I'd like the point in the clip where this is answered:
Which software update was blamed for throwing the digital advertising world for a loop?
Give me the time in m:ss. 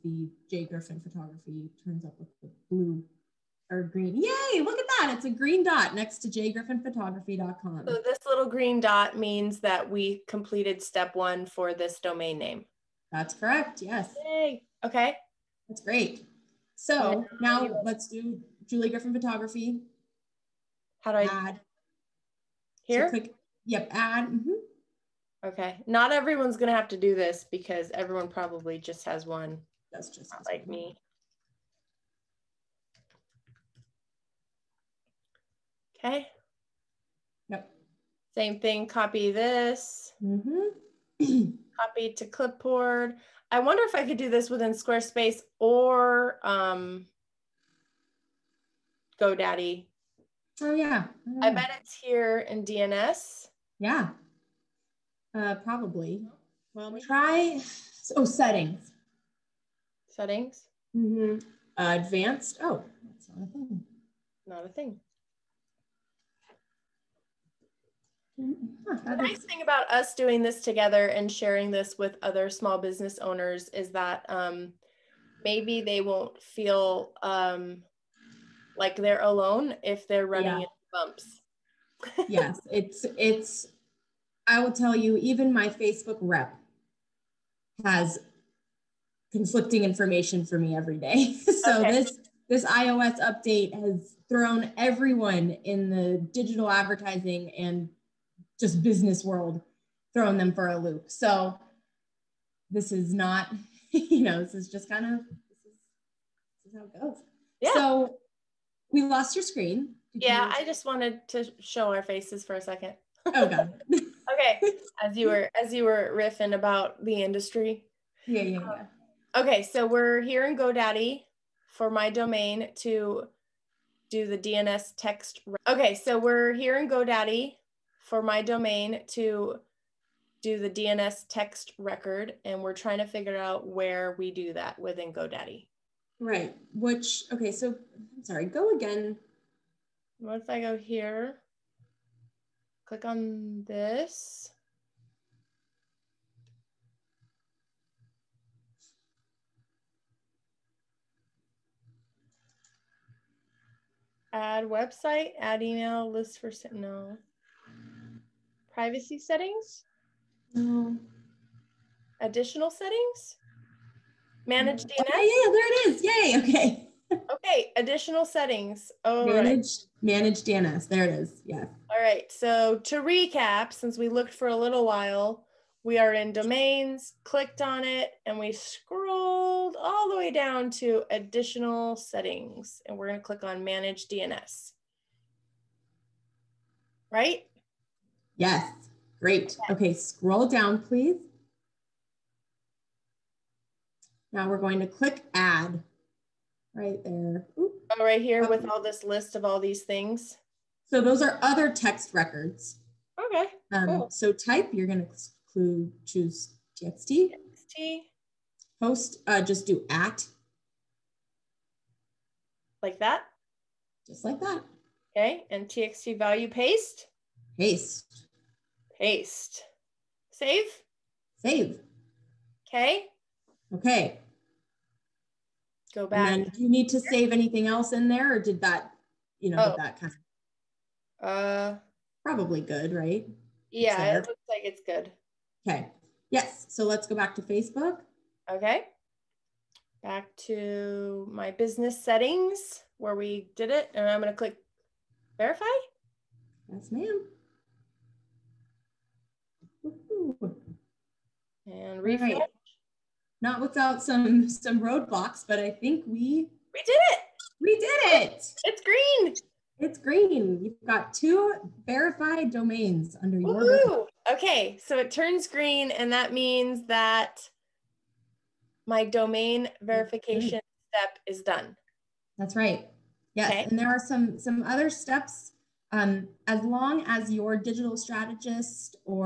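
1:32.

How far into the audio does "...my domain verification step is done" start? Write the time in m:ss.
4:28.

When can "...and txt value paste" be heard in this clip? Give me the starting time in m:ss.
3:35.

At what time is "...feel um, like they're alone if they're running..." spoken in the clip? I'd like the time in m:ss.
1:16.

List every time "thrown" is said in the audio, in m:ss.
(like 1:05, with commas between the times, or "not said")
1:34, 1:40.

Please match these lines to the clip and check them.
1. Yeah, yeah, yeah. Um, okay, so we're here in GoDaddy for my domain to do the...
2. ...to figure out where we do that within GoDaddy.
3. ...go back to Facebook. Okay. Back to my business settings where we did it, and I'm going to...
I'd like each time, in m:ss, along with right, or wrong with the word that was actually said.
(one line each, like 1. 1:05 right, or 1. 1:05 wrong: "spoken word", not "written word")
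1. 1:58 right
2. 2:12 right
3. 3:57 right.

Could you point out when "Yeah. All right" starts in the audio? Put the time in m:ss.
2:51.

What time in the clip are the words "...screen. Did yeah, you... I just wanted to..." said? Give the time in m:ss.
1:49.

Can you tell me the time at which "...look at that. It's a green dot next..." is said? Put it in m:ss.
0:04.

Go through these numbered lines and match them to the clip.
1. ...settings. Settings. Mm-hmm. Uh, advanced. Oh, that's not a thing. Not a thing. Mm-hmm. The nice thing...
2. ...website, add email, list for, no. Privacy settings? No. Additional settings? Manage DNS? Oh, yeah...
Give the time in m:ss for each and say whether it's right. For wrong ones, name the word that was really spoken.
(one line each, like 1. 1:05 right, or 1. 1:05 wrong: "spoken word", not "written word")
1. 0:58 right
2. 2:34 right.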